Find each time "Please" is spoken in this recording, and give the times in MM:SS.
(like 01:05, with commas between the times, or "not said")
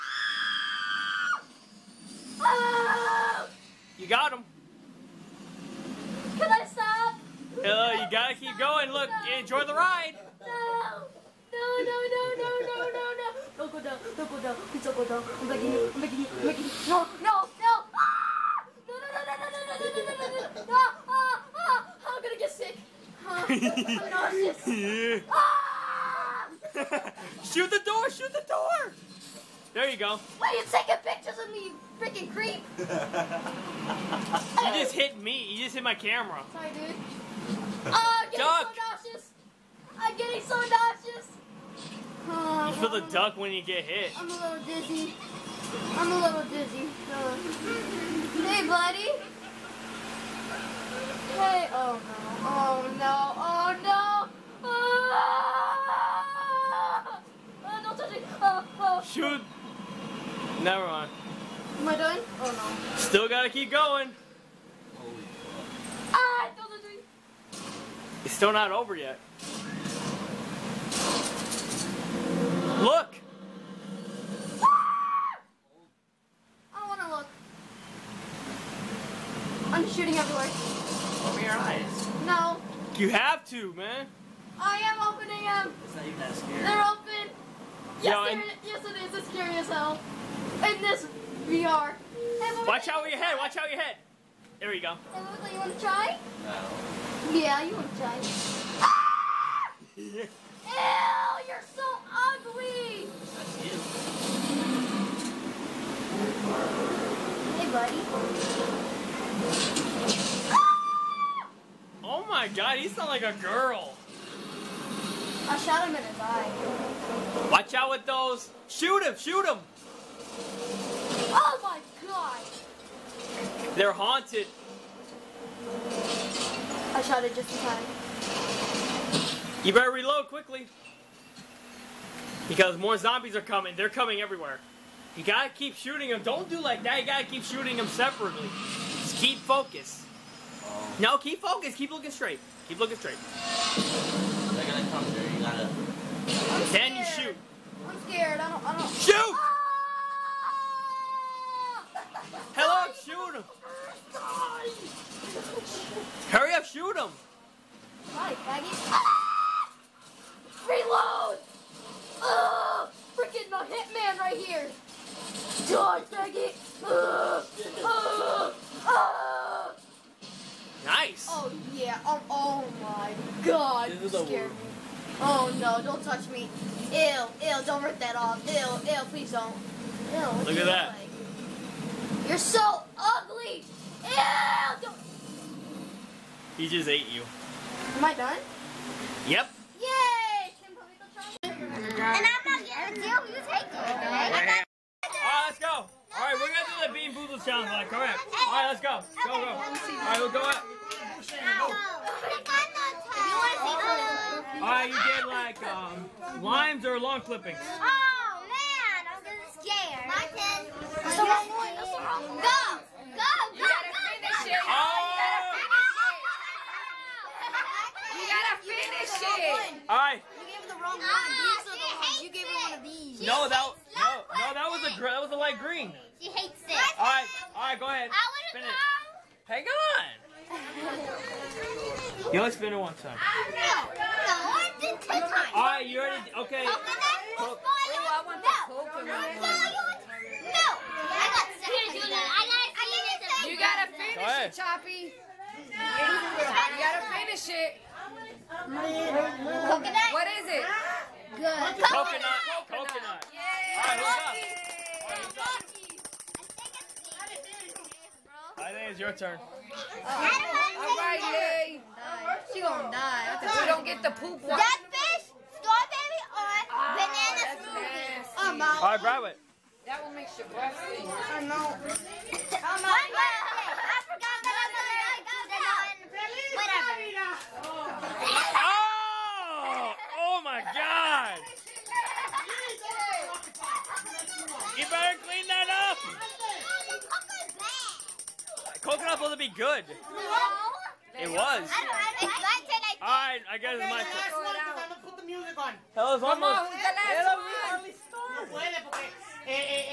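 00:14, 02:59.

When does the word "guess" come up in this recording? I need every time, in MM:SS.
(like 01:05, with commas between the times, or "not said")
04:53.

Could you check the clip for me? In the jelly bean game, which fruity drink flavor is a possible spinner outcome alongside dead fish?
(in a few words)
Banana smoothie.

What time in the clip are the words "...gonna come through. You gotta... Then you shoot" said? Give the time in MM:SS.
02:24.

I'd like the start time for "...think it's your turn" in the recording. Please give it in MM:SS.
04:18.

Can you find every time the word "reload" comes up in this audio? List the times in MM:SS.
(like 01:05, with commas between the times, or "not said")
02:09, 02:40.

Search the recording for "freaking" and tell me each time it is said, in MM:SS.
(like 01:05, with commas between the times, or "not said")
00:31, 02:43.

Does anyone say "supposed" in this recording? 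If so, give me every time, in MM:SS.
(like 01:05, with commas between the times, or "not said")
04:49.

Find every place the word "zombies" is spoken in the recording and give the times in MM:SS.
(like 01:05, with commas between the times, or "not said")
02:12.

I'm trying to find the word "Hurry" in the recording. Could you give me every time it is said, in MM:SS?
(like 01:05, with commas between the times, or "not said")
02:36.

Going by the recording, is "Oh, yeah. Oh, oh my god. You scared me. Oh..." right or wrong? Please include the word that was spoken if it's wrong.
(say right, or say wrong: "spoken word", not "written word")
right.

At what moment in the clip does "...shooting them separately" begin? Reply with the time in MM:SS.
02:17.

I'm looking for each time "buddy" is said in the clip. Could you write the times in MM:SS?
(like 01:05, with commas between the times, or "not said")
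00:48, 01:47.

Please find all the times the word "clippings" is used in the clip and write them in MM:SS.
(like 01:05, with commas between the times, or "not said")
03:27.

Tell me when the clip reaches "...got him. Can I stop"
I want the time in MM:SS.
00:04.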